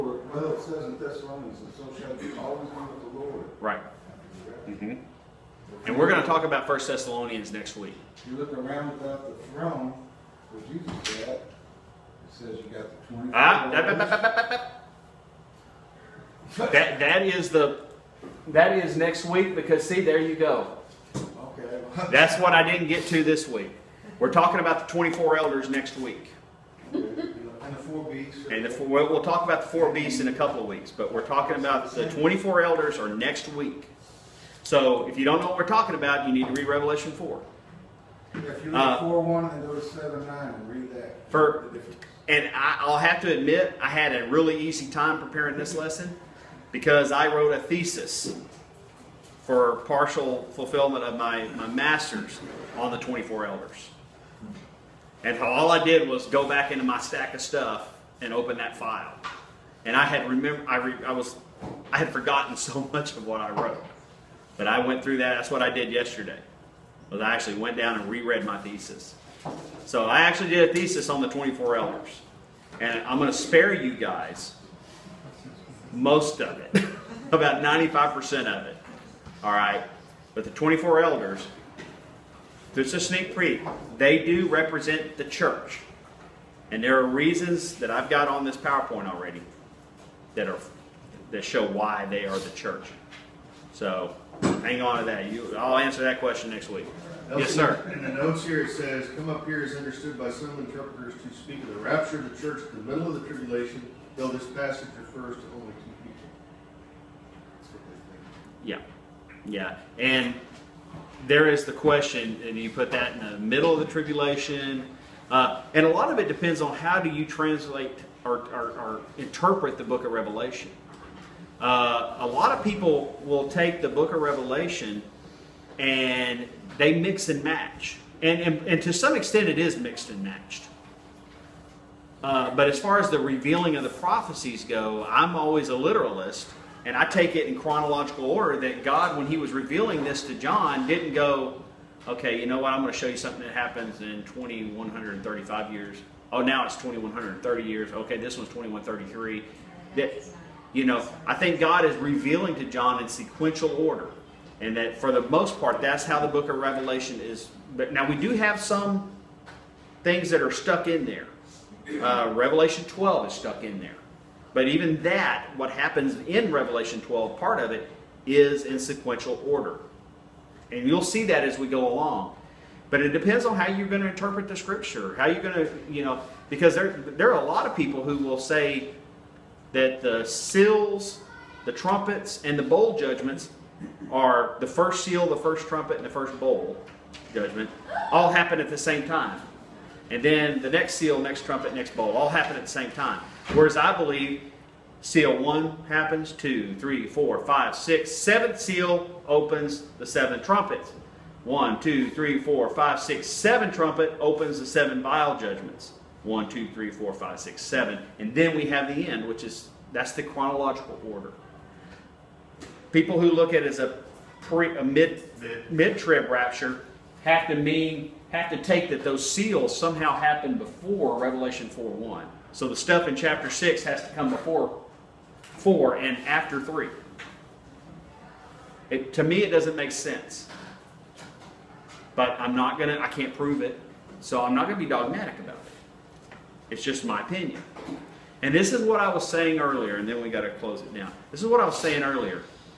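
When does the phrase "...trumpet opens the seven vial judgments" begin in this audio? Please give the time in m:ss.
3:23.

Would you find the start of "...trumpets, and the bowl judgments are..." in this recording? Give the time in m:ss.
3:01.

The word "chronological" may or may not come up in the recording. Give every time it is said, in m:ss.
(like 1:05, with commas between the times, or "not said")
2:17, 3:30.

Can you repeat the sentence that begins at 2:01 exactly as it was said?
Uh, a lot of people will take the book of Revelation and they mix and match.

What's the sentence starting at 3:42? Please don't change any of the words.
So the stuff in chapter 6 has to come before 4 and after 3.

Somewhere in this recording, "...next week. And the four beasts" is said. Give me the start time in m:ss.
0:25.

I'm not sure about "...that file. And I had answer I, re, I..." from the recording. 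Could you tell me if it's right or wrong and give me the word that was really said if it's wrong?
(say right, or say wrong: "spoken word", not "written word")
wrong: "remember", not "answer".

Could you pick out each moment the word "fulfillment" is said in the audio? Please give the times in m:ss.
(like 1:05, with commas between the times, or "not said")
0:50.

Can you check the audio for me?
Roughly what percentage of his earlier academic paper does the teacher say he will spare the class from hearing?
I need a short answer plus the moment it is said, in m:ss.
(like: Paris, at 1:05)
95%, at 1:17.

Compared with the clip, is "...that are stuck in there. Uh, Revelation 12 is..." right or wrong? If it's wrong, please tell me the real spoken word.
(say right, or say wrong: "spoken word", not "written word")
right.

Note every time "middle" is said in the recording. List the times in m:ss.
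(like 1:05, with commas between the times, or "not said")
1:42, 1:53.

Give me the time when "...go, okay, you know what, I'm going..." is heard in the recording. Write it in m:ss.
2:21.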